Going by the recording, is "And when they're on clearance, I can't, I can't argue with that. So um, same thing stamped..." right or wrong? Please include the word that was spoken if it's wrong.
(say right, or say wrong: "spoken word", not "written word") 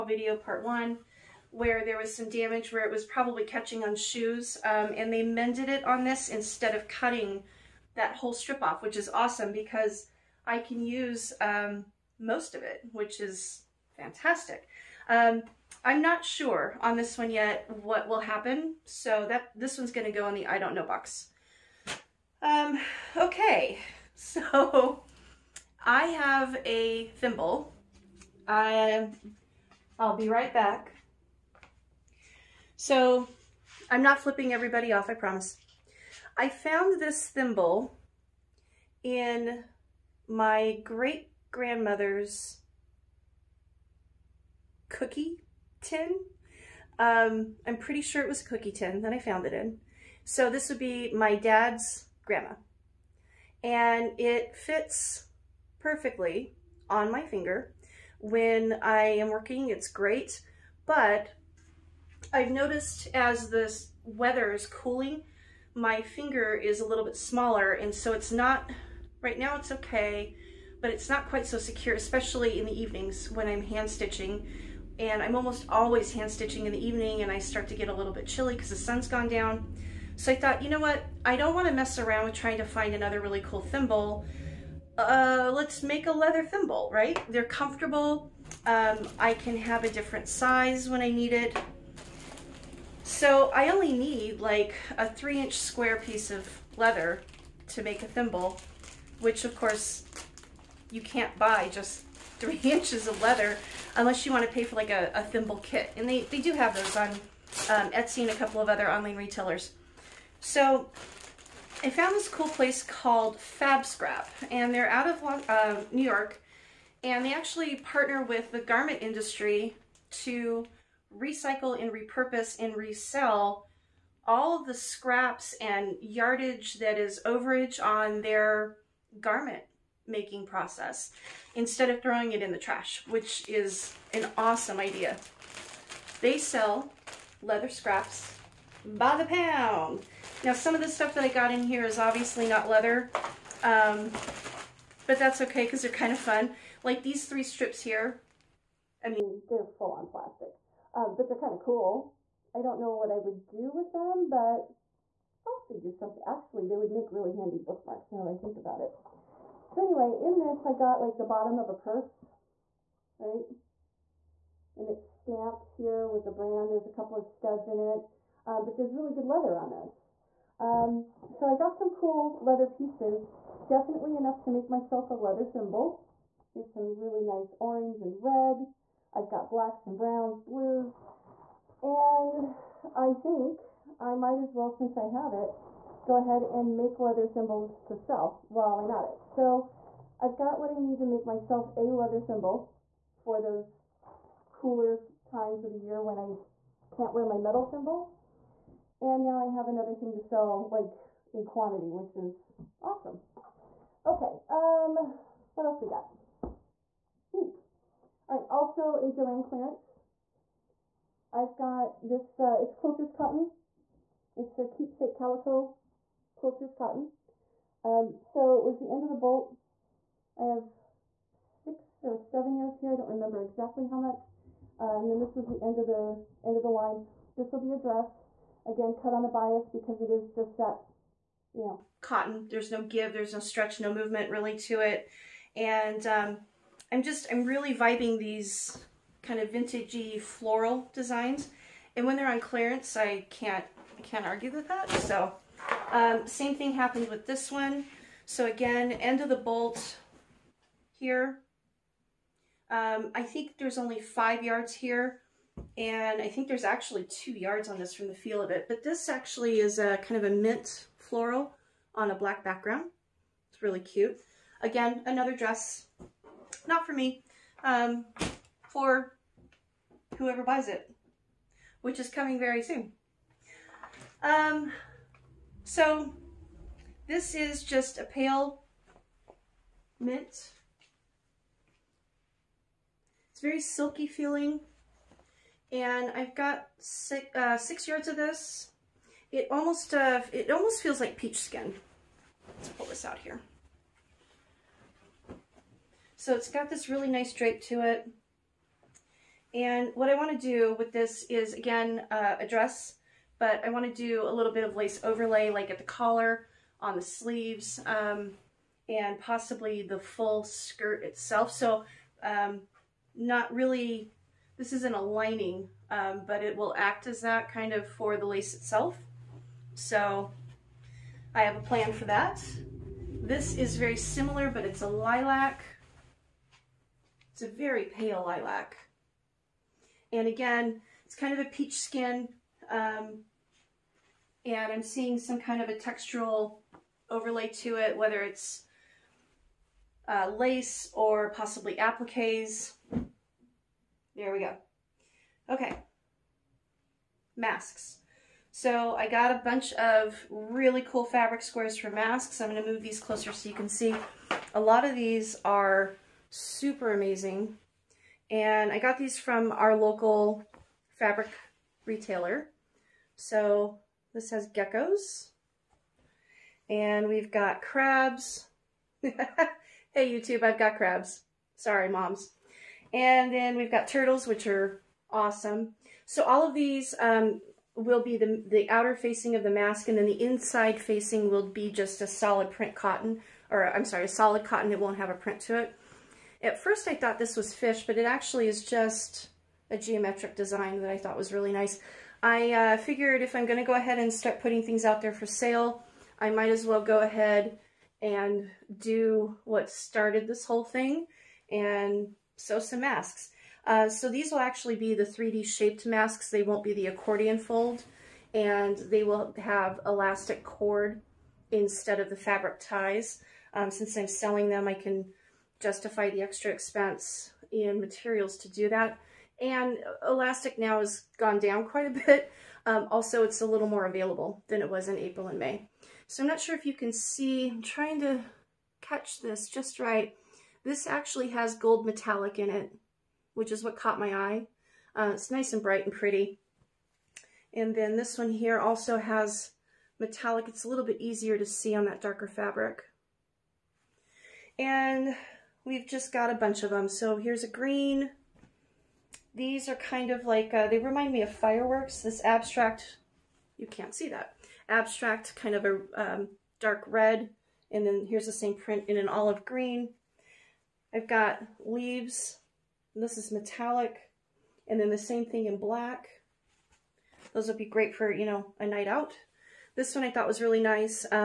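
wrong: "happened", not "stamped".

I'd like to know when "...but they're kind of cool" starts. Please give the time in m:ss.
2:31.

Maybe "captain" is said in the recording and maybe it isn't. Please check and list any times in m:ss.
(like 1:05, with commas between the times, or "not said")
not said.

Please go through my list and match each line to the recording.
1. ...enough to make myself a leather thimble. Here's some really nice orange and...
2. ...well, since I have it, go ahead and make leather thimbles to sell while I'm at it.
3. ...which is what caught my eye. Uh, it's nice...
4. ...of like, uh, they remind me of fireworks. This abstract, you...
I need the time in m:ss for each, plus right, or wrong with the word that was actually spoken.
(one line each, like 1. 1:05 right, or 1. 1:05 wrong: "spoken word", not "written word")
1. 2:54 right
2. 3:04 right
3. 7:13 right
4. 7:30 right.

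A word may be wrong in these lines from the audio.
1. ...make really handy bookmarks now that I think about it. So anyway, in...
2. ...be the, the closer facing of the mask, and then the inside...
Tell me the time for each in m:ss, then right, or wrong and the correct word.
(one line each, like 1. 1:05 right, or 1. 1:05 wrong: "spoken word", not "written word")
1. 2:36 right
2. 6:18 wrong: "outer", not "closer".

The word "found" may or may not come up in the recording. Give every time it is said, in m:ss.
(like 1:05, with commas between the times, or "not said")
0:36, 0:49, 1:51.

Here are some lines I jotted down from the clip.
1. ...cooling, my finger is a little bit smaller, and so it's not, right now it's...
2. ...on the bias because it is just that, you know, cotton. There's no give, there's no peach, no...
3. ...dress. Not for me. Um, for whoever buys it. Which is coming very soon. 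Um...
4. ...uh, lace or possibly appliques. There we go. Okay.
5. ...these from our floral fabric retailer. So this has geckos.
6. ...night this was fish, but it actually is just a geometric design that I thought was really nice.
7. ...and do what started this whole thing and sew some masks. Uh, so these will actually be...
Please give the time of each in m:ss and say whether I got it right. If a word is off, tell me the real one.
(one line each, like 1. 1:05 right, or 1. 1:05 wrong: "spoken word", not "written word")
1. 1:04 right
2. 3:49 wrong: "stretch", not "peach"
3. 4:25 right
4. 5:40 right
5. 5:58 wrong: "local", not "floral"
6. 6:26 wrong: "thought", not "night"
7. 6:38 right.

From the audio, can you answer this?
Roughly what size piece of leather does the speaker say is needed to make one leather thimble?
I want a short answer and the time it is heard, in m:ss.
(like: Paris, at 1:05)
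3 inch square, at 1:35.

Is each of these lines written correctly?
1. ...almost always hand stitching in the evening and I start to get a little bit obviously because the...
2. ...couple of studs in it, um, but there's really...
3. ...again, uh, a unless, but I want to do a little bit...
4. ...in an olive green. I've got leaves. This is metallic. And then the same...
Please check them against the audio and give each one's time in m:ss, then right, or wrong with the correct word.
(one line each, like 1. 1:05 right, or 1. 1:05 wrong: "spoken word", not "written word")
1. 1:15 wrong: "chilly", not "obviously"
2. 2:46 right
3. 5:01 wrong: "dress", not "unless"
4. 7:38 right.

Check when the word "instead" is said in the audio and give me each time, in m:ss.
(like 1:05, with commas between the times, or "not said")
0:06, 2:11, 6:51.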